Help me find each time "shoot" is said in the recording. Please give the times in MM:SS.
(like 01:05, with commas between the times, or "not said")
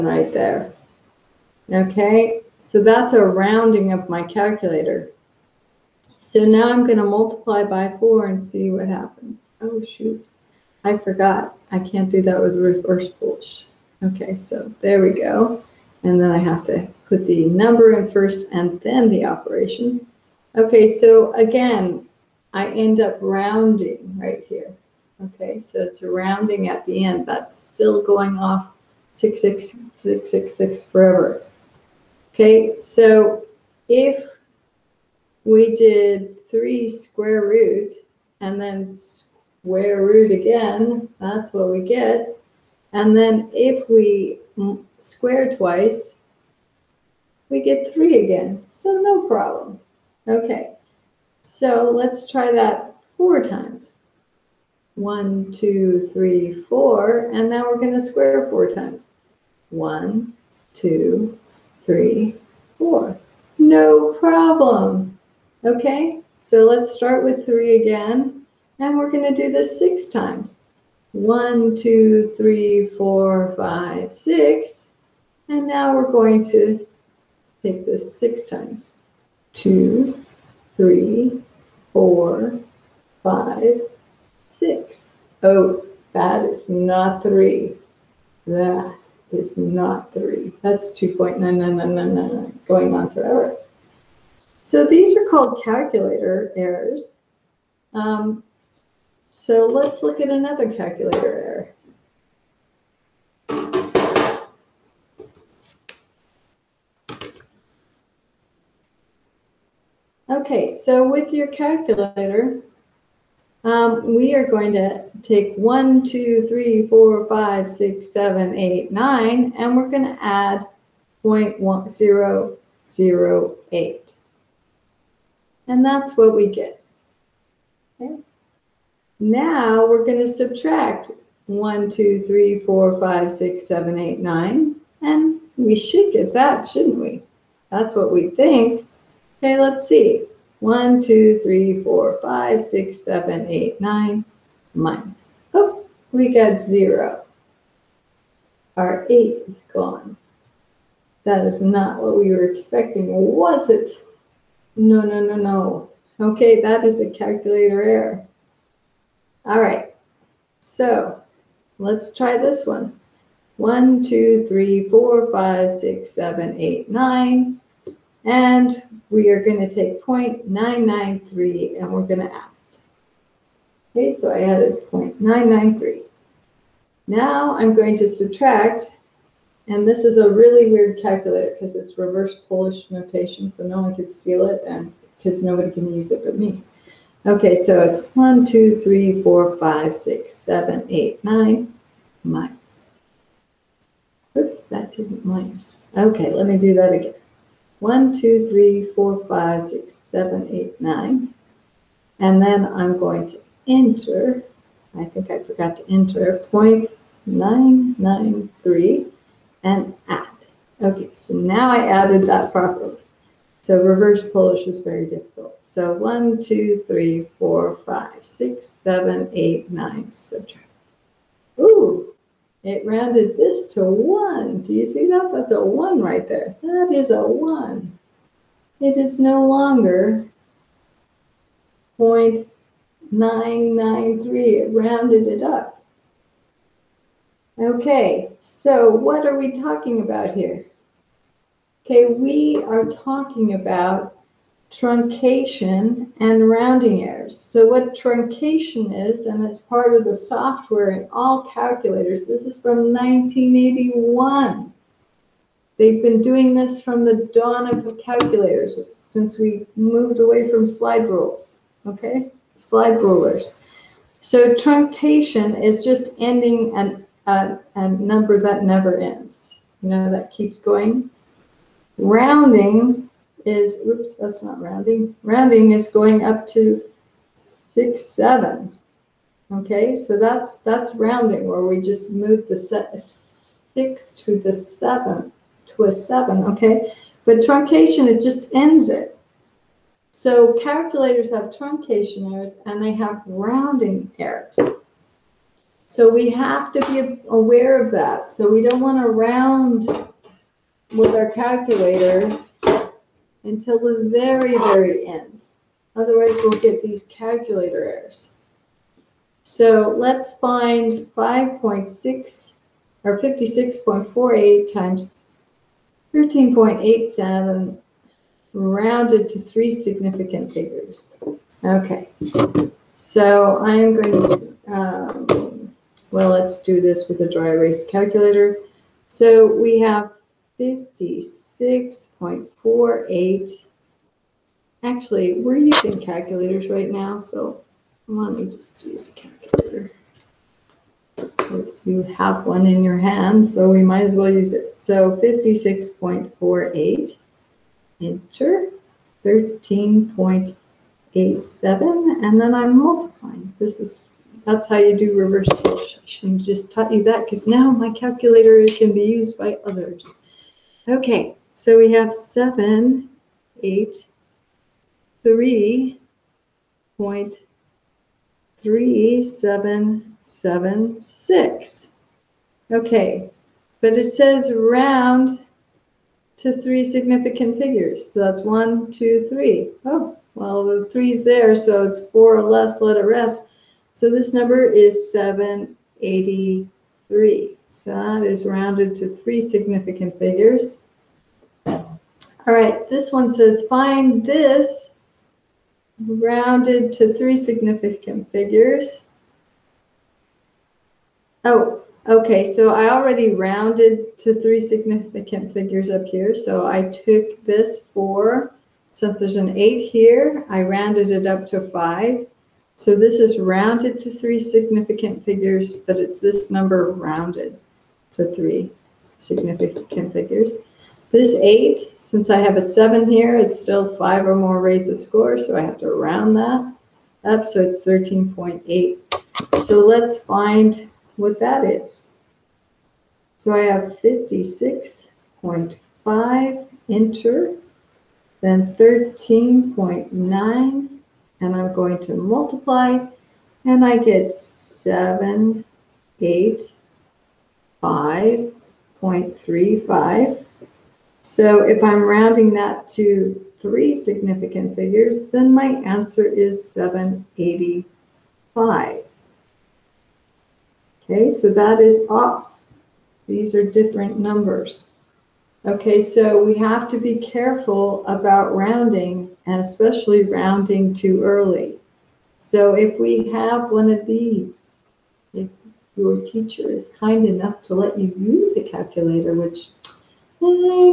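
00:09.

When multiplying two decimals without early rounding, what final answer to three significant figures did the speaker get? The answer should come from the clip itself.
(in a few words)
783.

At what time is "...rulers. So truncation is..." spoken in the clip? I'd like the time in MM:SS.
04:23.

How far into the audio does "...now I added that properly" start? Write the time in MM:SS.
03:31.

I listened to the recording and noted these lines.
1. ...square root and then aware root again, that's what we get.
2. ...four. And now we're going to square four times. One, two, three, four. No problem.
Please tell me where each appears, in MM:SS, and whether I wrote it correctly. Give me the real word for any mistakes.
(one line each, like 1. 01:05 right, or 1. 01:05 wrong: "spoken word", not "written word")
1. 00:36 wrong: "square", not "aware"
2. 00:56 right.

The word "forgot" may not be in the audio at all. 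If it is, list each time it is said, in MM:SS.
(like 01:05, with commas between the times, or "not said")
00:10, 03:25.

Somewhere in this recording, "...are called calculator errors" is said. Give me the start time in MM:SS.
01:35.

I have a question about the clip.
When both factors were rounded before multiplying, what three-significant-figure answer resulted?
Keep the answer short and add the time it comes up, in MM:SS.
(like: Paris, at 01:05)
785, at 07:36.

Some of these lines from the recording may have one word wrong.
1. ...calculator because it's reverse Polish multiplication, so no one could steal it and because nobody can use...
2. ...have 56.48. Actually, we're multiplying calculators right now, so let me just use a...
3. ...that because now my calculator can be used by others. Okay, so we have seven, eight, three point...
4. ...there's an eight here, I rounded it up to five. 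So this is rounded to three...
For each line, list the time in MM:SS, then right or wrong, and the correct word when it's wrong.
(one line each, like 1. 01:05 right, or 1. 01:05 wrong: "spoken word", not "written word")
1. 03:01 wrong: "notation", not "multiplication"
2. 05:29 wrong: "using", not "multiplying"
3. 05:57 right
4. 06:49 right.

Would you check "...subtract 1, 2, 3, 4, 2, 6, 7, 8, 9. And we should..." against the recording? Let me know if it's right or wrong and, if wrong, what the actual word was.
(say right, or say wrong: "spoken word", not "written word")
wrong: "5", not "2".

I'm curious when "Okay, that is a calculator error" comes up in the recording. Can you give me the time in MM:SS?
02:36.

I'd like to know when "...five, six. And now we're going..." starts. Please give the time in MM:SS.
01:13.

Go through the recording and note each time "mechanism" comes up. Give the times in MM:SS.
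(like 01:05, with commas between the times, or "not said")
not said.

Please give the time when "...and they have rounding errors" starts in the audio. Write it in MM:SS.
04:52.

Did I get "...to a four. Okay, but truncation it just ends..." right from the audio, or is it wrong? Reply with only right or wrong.
wrong.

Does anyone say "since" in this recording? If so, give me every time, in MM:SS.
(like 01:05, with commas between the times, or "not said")
04:19, 06:48, 07:01.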